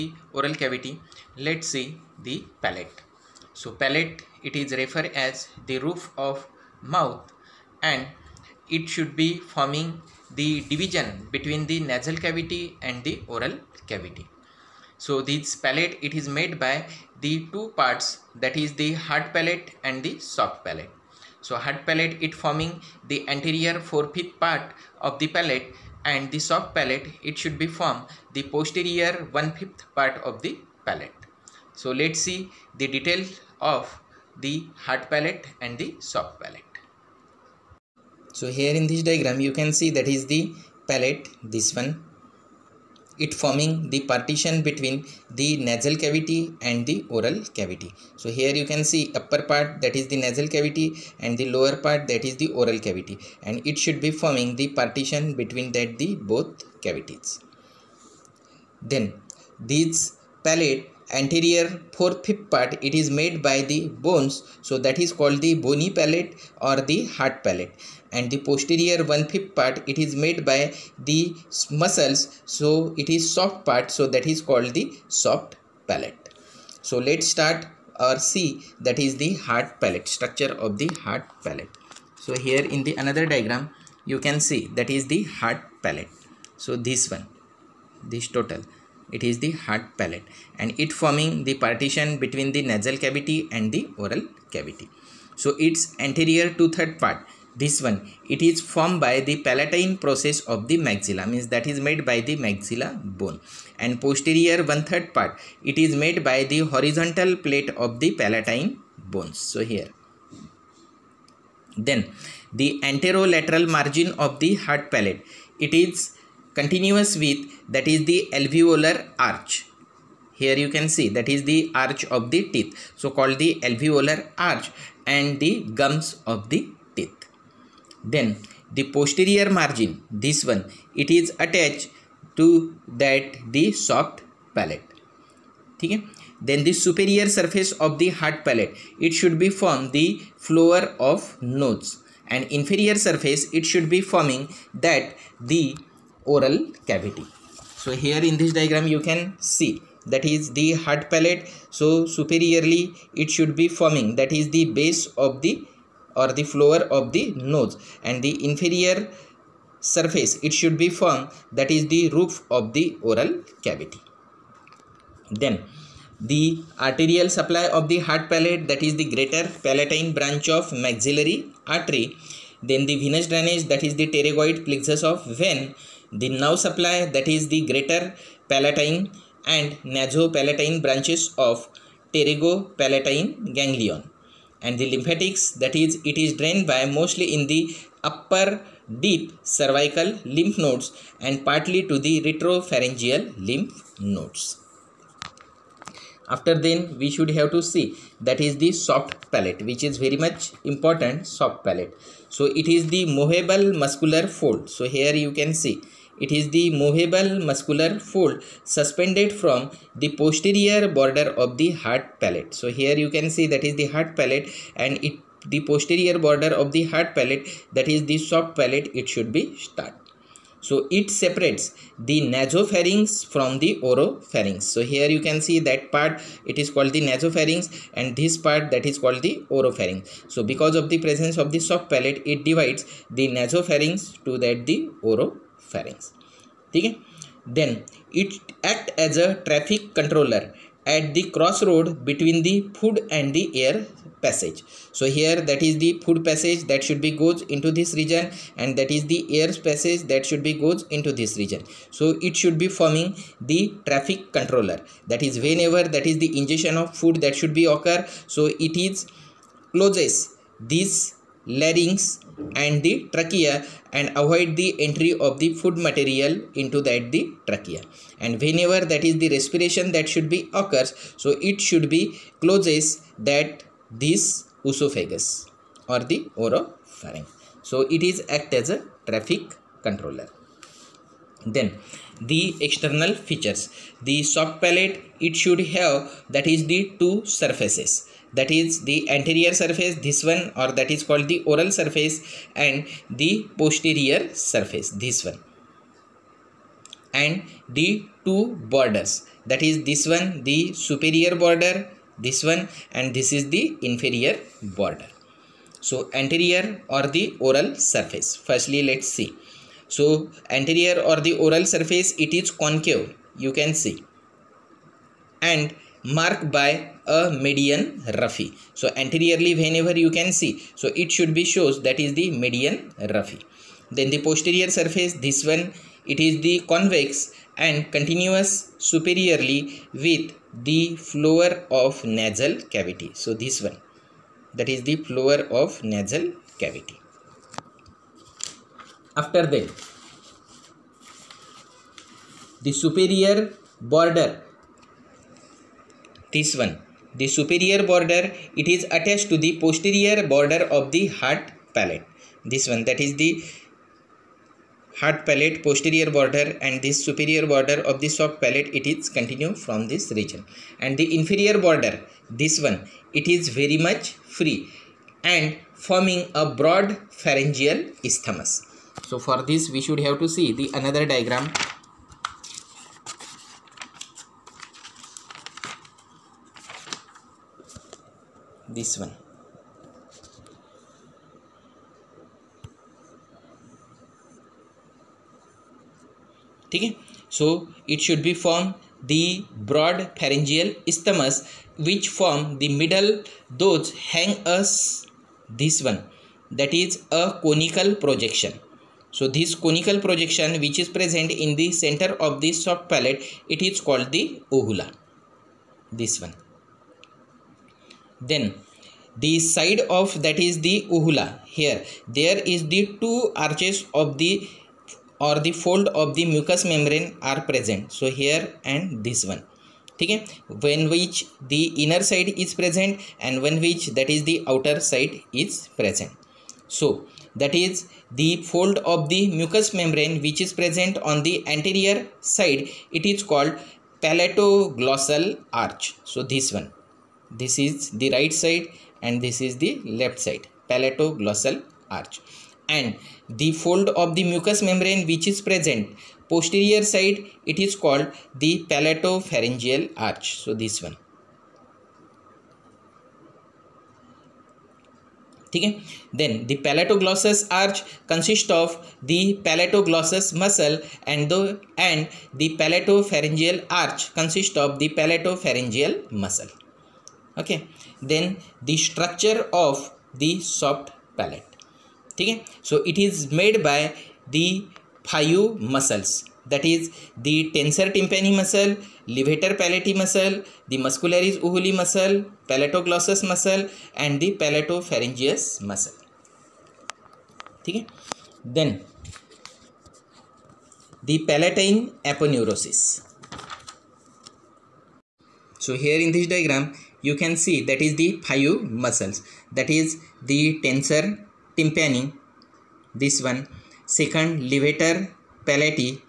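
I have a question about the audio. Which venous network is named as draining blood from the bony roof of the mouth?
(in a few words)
pterygoid plexus.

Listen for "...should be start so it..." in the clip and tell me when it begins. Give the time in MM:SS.
03:39.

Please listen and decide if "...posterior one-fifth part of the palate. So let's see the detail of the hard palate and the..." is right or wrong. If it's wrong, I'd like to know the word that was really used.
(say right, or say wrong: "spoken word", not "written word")
right.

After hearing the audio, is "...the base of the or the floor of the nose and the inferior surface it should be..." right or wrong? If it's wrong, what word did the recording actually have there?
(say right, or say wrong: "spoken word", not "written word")
right.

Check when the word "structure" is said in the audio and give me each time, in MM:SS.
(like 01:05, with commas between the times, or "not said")
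01:20, 07:48.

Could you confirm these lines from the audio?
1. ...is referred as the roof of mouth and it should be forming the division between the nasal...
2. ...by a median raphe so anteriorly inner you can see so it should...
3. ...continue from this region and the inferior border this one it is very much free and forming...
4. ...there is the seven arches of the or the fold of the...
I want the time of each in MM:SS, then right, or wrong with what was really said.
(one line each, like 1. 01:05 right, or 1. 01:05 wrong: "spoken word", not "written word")
1. 00:04 right
2. 05:16 wrong: "whenever", not "inner"
3. 05:59 right
4. 06:52 wrong: "two", not "seven".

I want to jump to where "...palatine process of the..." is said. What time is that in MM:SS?
01:39.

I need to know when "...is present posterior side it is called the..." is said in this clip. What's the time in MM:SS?
07:25.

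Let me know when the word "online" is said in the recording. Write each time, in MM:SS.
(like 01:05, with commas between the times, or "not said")
not said.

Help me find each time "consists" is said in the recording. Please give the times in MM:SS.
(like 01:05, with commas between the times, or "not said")
07:38, 07:44.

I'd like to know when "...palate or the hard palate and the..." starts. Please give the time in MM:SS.
01:05.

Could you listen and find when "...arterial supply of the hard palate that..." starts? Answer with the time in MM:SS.
02:46.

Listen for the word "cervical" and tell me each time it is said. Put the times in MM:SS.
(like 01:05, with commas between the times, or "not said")
03:09.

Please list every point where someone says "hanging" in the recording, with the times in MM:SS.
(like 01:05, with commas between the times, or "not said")
not said.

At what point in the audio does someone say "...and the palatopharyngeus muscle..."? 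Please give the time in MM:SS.
08:03.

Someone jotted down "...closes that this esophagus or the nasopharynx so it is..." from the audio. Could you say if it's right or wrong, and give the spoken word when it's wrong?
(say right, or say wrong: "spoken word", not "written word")
wrong: "oropharynx", not "nasopharynx".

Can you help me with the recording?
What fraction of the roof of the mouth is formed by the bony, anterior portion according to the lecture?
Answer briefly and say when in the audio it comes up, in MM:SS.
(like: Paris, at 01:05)
four fifth, at 00:23.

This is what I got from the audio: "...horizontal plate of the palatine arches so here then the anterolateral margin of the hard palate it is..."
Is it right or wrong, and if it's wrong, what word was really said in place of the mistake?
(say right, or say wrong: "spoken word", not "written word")
wrong: "bones", not "arches".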